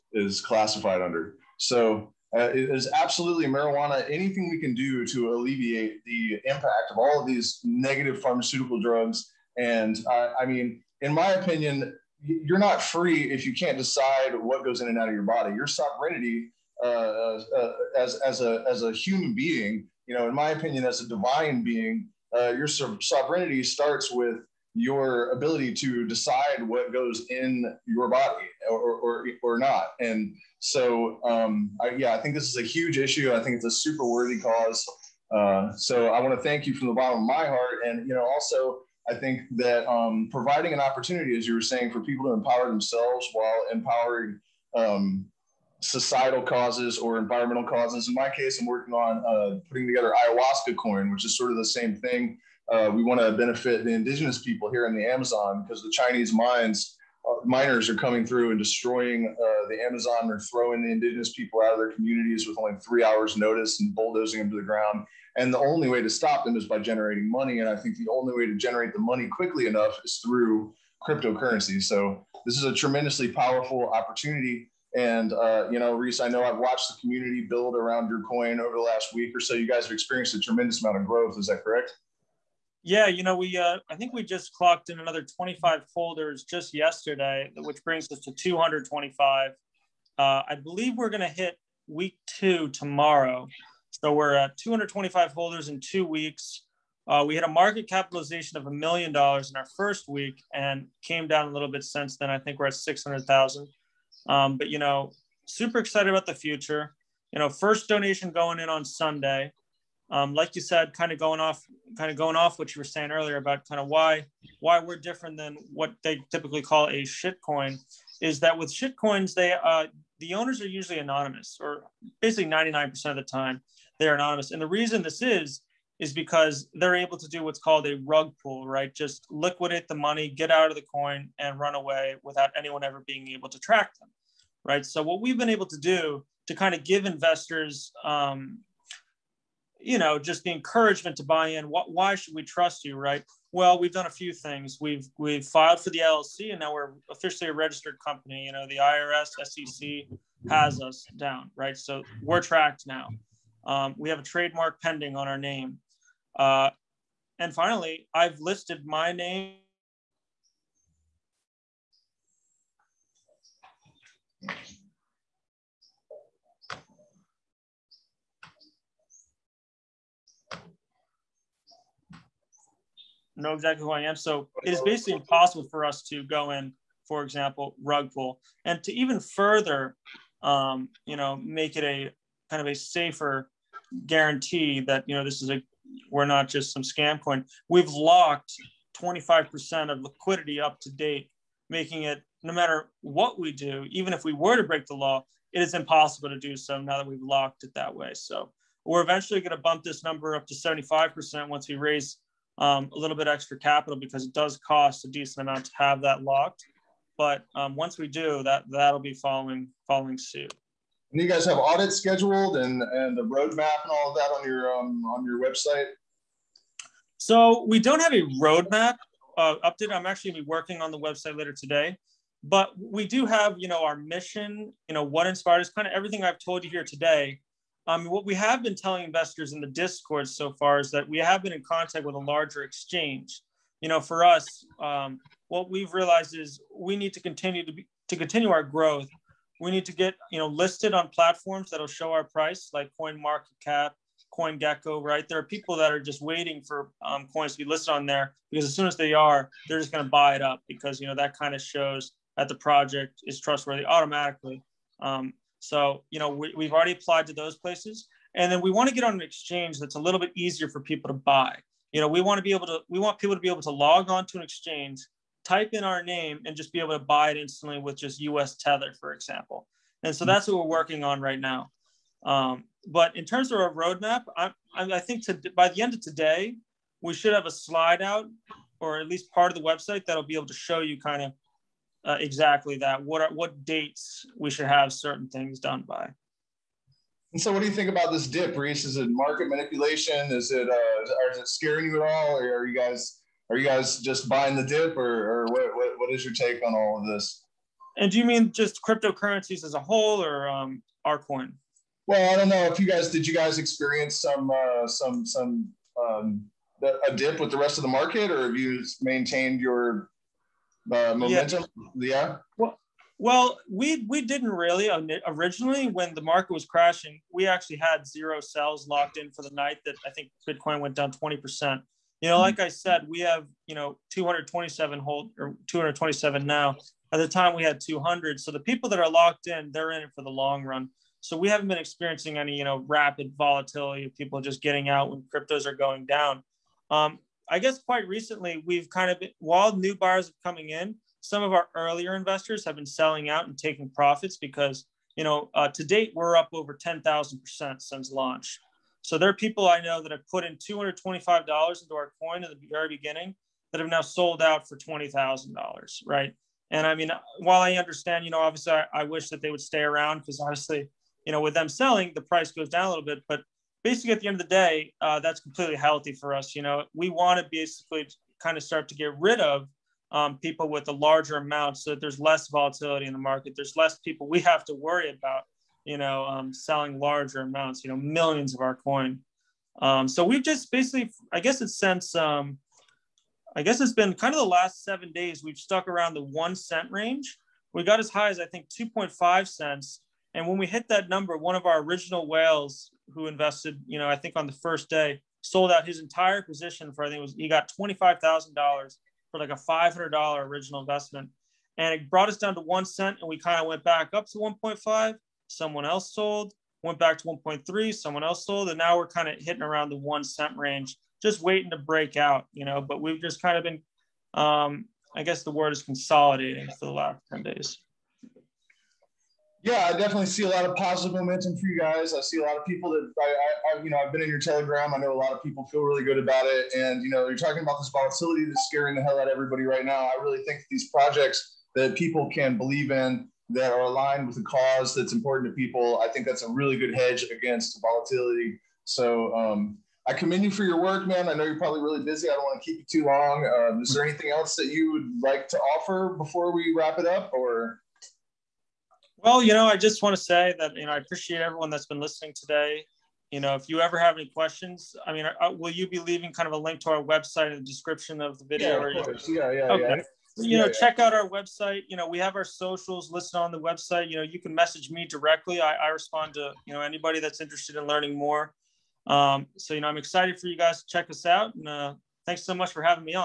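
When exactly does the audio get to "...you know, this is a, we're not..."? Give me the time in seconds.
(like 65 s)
185 s.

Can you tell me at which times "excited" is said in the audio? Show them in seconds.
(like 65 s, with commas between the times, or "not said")
105 s, 469 s.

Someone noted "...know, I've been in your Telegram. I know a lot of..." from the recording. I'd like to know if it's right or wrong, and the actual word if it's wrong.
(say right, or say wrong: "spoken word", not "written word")
right.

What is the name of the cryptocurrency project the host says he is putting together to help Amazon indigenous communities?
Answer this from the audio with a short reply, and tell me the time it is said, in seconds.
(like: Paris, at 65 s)
Ayahuasca coin, at 50 s.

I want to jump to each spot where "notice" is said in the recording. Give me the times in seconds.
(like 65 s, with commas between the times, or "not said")
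63 s.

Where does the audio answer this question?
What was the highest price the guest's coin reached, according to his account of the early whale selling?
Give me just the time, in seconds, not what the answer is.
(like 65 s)
388 s.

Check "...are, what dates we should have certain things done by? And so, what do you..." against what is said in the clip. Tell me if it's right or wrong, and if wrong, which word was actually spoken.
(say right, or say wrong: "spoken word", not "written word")
right.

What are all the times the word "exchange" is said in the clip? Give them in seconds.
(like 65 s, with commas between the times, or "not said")
232 s, 259 s, 264 s.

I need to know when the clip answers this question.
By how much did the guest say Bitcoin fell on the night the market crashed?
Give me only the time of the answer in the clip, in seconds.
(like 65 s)
321 s.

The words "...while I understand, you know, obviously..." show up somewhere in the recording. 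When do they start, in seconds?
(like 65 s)
357 s.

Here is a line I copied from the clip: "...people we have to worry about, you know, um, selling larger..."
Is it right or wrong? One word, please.
right.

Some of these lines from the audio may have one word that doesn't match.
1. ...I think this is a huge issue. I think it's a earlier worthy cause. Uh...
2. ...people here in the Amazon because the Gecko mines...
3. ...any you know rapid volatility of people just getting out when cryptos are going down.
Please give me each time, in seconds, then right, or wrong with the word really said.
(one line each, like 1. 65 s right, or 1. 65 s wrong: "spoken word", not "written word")
1. 32 s wrong: "super", not "earlier"
2. 54 s wrong: "Chinese", not "Gecko"
3. 332 s right.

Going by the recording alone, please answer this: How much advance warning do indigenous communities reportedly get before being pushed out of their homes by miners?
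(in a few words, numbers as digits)
3 hours.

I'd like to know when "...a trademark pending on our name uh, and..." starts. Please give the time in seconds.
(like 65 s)
154 s.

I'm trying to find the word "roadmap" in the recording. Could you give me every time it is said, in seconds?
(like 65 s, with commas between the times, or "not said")
213 s, 218 s, 273 s.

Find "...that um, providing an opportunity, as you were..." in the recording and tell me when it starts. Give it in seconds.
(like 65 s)
39 s.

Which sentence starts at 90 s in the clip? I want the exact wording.
Uh, I believe we're going to hit week two tomorrow, so we're at 225 holders in two weeks.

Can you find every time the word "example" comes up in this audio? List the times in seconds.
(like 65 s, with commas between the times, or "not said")
177 s, 269 s.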